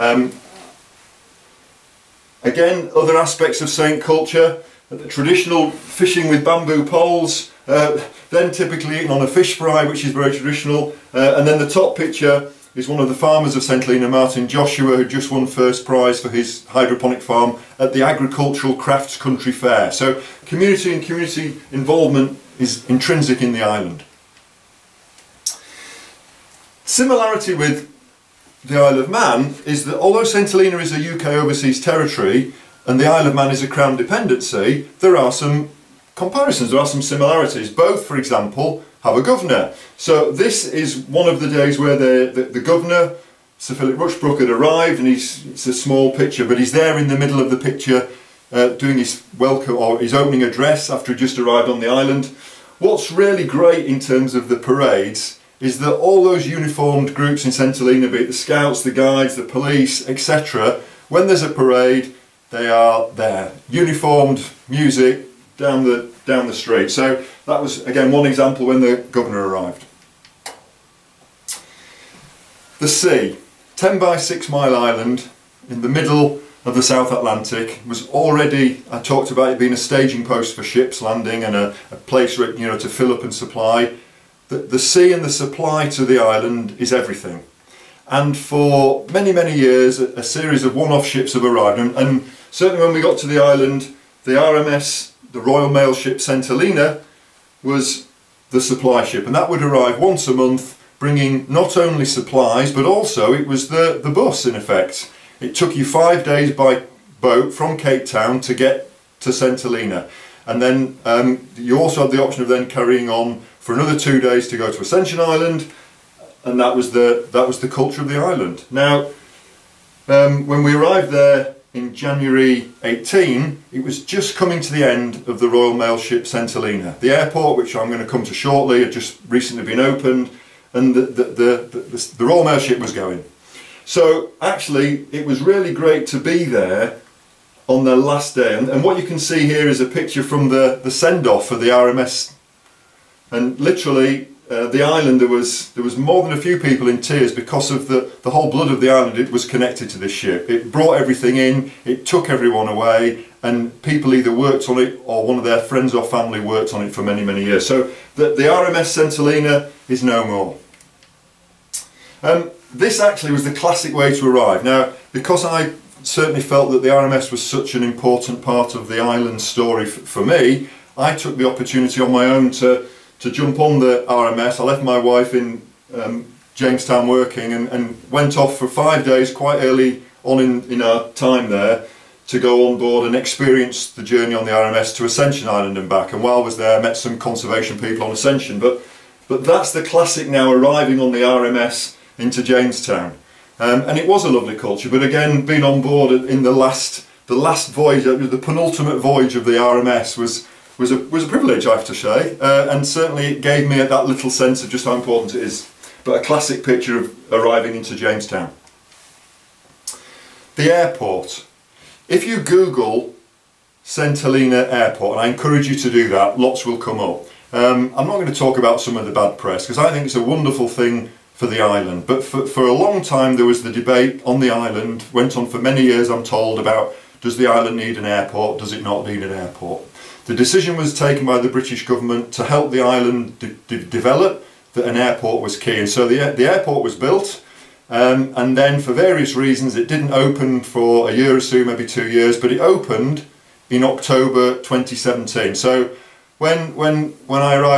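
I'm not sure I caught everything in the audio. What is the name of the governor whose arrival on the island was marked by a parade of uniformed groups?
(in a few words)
Sir Philip Rushbrook.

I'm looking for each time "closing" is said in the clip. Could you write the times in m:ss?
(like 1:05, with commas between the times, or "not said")
not said.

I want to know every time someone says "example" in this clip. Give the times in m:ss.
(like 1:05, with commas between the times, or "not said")
0:38, 1:08.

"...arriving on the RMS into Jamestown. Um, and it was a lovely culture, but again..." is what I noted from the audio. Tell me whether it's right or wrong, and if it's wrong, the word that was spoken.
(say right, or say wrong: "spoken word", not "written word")
right.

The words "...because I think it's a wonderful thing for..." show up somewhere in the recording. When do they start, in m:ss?
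3:39.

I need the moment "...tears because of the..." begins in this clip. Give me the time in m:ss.
2:27.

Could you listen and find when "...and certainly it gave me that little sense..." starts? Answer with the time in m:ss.
3:22.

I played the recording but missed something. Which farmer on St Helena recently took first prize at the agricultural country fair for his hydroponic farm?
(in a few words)
Martin Joshua.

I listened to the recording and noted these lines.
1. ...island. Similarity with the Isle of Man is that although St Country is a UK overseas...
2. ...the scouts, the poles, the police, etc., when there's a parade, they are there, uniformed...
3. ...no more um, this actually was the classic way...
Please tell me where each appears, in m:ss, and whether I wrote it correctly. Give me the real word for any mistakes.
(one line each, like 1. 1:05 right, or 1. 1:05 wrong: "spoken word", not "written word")
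1. 0:23 wrong: "Helena", not "Country"
2. 0:58 wrong: "guides", not "poles"
3. 2:40 right.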